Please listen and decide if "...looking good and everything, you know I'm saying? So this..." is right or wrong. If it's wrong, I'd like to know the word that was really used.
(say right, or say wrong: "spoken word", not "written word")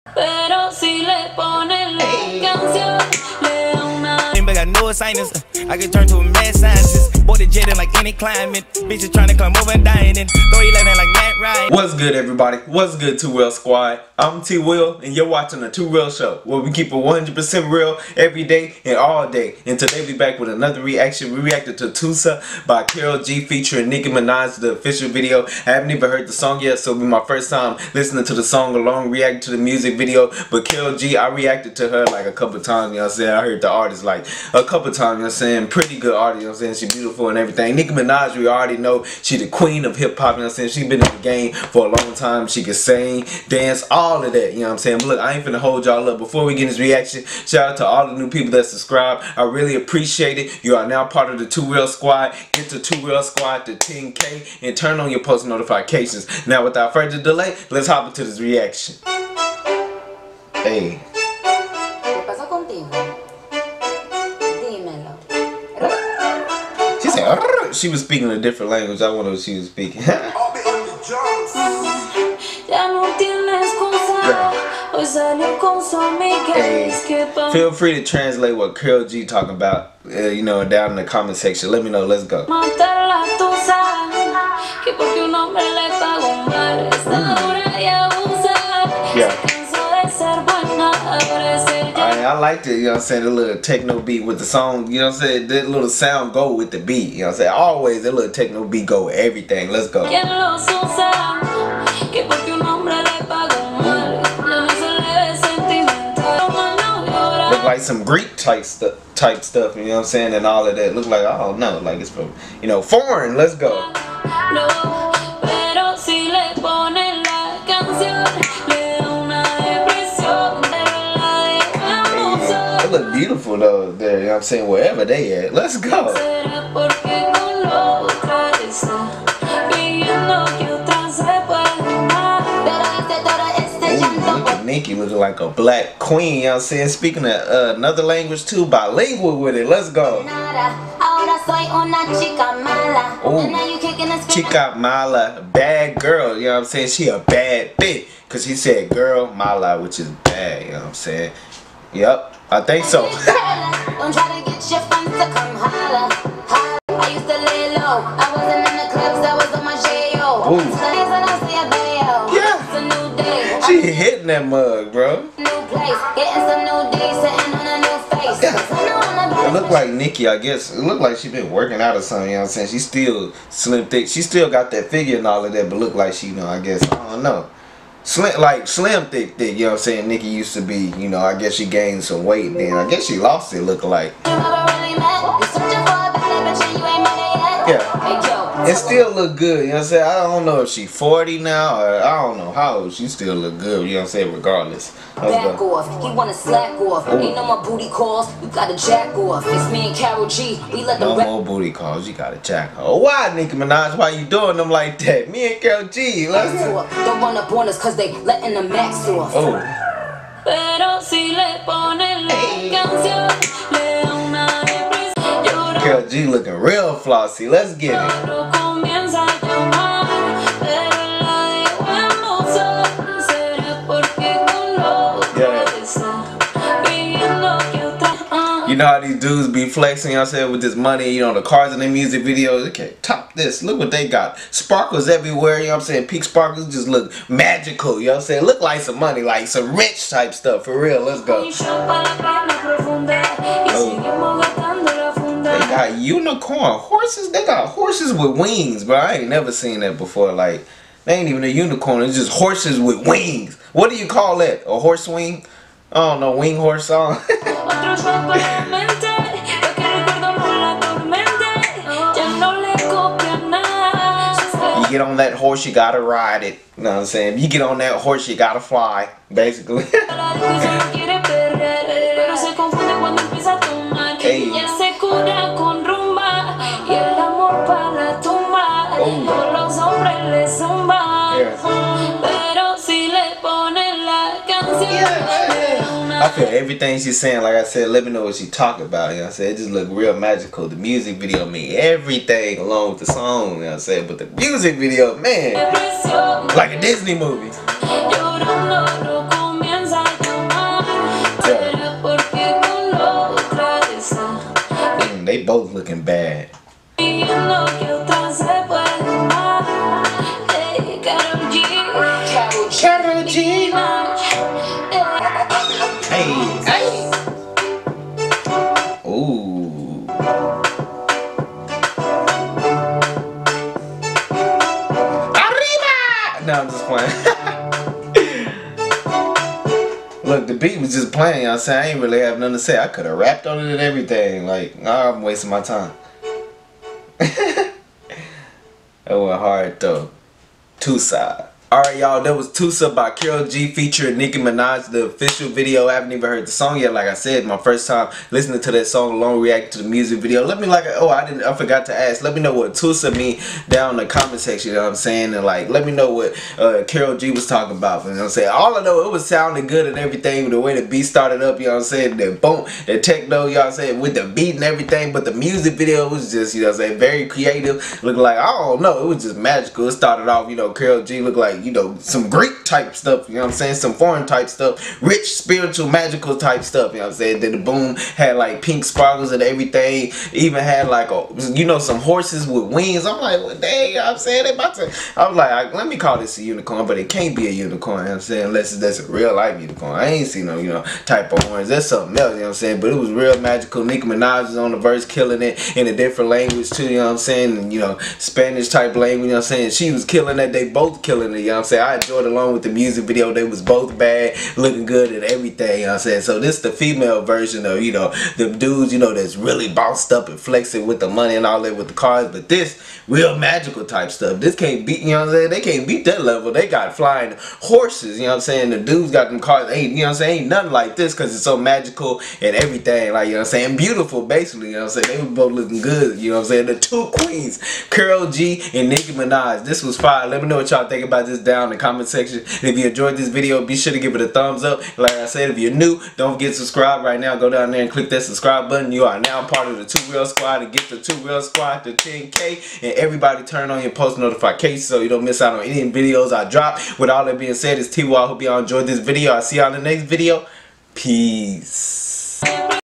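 right.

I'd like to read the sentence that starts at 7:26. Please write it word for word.
With all that being said, it's T.Y.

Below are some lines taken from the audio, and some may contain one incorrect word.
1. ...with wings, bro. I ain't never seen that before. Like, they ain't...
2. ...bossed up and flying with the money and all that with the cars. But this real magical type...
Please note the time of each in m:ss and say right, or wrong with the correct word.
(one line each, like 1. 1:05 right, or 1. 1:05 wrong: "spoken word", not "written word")
1. 4:08 right
2. 6:49 wrong: "flexing", not "flying".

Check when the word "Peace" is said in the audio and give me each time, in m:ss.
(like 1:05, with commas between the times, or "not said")
7:30.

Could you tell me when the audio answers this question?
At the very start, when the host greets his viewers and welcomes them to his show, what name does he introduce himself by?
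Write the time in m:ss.
0:14.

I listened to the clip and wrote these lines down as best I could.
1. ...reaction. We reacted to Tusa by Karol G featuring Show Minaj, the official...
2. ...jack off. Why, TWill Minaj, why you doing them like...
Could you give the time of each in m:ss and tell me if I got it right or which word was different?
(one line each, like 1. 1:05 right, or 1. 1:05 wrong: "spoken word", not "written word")
1. 0:20 wrong: "Nicki", not "Show"
2. 3:22 wrong: "Nicki", not "TWill".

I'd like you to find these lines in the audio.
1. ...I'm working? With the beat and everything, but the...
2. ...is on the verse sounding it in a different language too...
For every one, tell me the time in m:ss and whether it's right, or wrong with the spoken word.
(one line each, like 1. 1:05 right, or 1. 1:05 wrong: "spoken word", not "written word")
1. 6:03 wrong: "saying", not "working"
2. 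6:34 wrong: "killing", not "sounding".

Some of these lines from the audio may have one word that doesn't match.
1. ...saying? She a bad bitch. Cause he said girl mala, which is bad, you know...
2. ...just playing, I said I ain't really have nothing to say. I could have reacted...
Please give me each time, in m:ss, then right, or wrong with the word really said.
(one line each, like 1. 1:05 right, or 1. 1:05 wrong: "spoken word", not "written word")
1. 2:26 right
2. 5:30 wrong: "rapped", not "reacted".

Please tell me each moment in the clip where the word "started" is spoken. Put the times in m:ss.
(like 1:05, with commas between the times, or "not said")
6:01, 6:09.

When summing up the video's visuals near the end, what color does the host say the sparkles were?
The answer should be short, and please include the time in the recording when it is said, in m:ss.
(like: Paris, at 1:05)
pink, at 6:18.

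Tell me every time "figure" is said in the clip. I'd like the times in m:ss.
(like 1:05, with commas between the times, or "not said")
2:54.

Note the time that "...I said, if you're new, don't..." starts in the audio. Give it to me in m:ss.
7:15.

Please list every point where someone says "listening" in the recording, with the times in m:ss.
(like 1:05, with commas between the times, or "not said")
0:27, 5:48.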